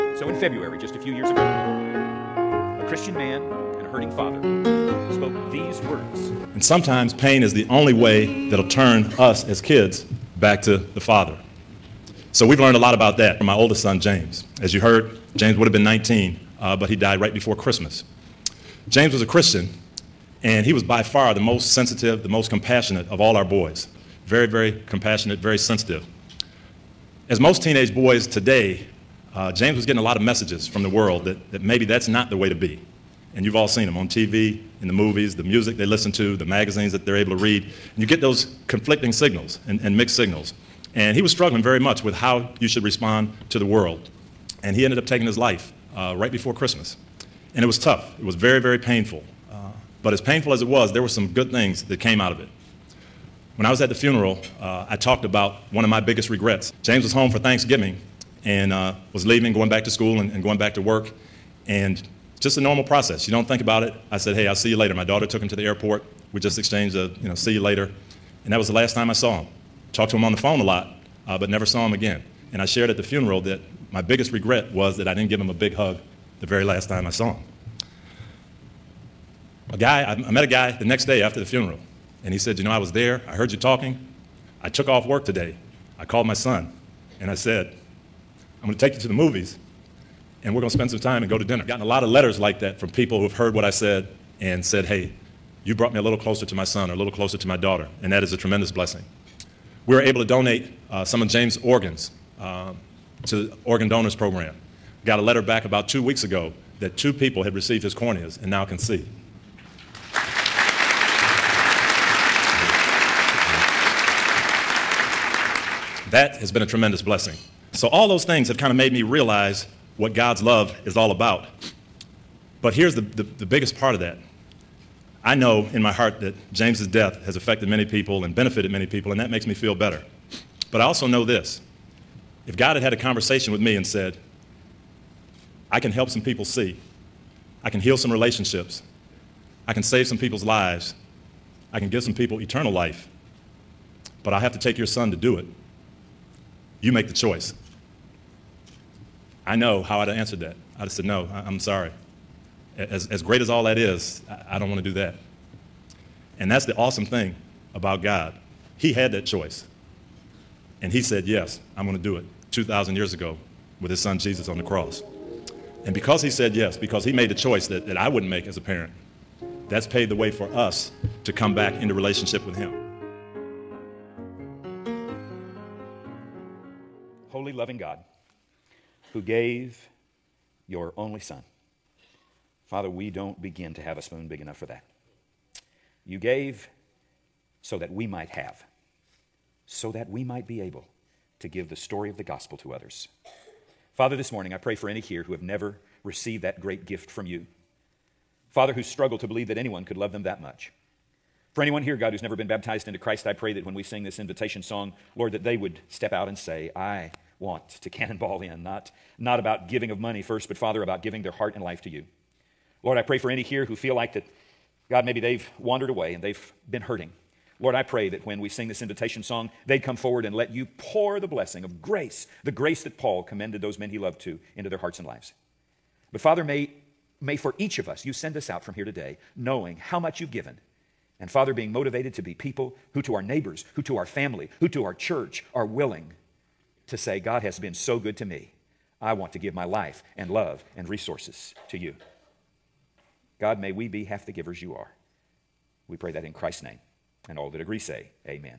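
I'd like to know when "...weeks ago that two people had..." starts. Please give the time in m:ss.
1:46.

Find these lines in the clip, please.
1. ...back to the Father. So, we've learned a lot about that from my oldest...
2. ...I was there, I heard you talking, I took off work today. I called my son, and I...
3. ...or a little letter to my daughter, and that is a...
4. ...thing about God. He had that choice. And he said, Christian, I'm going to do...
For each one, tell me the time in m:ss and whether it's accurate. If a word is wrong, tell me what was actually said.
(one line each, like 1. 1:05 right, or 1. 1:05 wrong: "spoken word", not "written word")
1. 0:10 right
2. 1:22 right
3. 1:36 wrong: "closer", not "letter"
4. 2:37 wrong: "Yes", not "Christian".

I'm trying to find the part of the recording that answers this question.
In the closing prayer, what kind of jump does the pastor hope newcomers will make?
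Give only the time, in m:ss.
3:27.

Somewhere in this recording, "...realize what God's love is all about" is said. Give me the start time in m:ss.
1:59.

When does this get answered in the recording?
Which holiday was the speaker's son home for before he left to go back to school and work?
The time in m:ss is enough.
0:57.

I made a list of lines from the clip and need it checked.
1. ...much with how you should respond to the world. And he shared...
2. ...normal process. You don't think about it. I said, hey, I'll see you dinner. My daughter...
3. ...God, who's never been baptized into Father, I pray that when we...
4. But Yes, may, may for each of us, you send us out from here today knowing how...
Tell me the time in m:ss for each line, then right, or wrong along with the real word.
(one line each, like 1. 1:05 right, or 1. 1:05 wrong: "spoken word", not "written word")
1. 0:41 wrong: "ended", not "shared"
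2. 1:02 wrong: "later", not "dinner"
3. 3:21 wrong: "Christ", not "Father"
4. 3:46 wrong: "Father", not "Yes".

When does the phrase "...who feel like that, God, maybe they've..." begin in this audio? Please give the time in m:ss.
3:33.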